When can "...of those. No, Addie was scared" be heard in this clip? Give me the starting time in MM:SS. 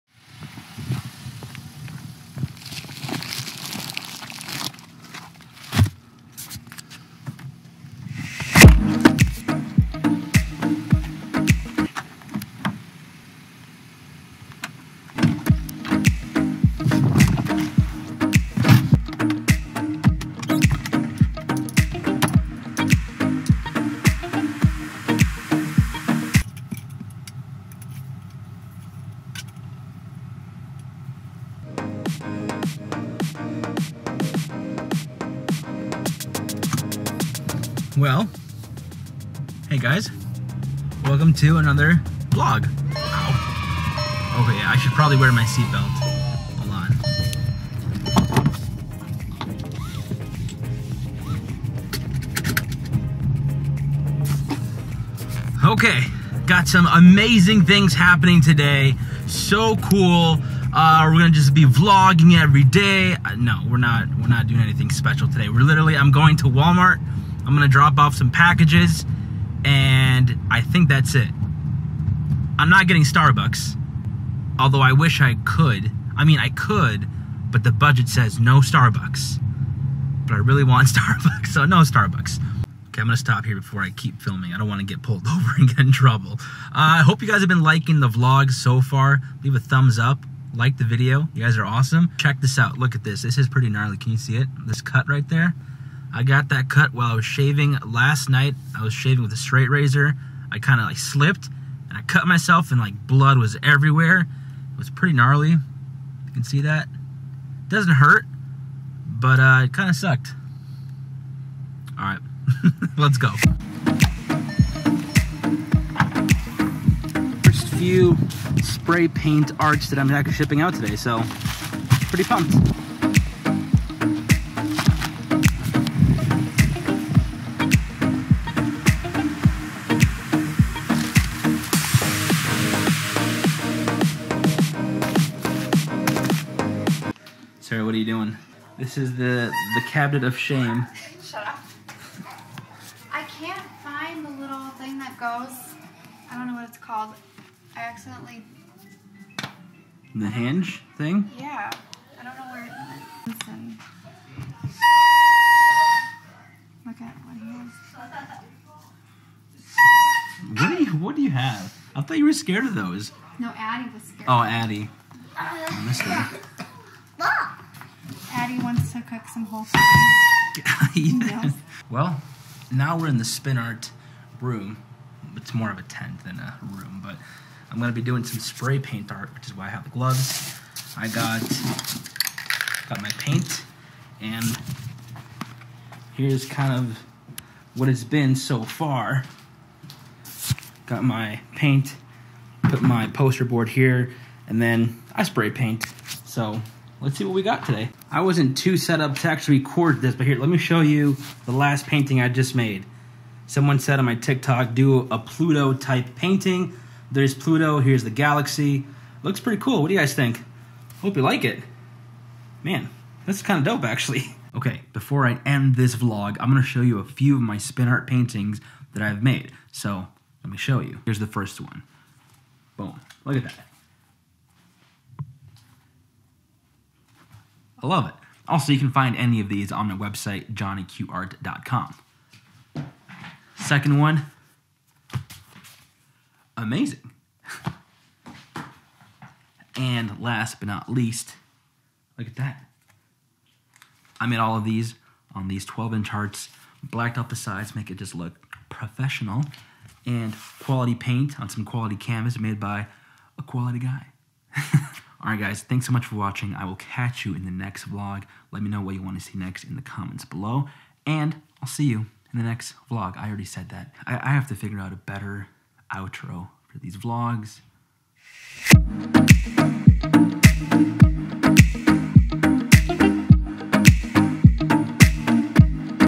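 02:42.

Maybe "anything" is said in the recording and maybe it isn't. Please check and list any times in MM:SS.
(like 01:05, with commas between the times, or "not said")
01:04.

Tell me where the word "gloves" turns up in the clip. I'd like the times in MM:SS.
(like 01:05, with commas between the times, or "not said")
02:59.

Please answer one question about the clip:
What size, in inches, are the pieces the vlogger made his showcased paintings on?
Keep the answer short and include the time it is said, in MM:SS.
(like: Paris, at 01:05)
12 inch, at 04:05.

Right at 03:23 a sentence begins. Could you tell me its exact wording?
Someone said on my TikTok, do a Pluto type painting.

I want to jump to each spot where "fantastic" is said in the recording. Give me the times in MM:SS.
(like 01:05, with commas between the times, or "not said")
not said.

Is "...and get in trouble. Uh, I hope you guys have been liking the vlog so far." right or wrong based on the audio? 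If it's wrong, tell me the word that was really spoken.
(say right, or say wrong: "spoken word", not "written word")
right.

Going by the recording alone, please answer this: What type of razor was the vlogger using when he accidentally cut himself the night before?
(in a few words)
straight razor.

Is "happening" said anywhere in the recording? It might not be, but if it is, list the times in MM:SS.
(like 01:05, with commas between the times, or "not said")
00:57.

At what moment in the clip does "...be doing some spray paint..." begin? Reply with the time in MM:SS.
02:57.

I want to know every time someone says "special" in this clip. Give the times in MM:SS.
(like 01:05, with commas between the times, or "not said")
01:04.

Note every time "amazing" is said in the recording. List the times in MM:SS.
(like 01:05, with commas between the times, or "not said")
00:56, 03:56.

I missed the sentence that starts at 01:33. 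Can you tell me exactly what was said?
This is pretty gnarly, can you see it?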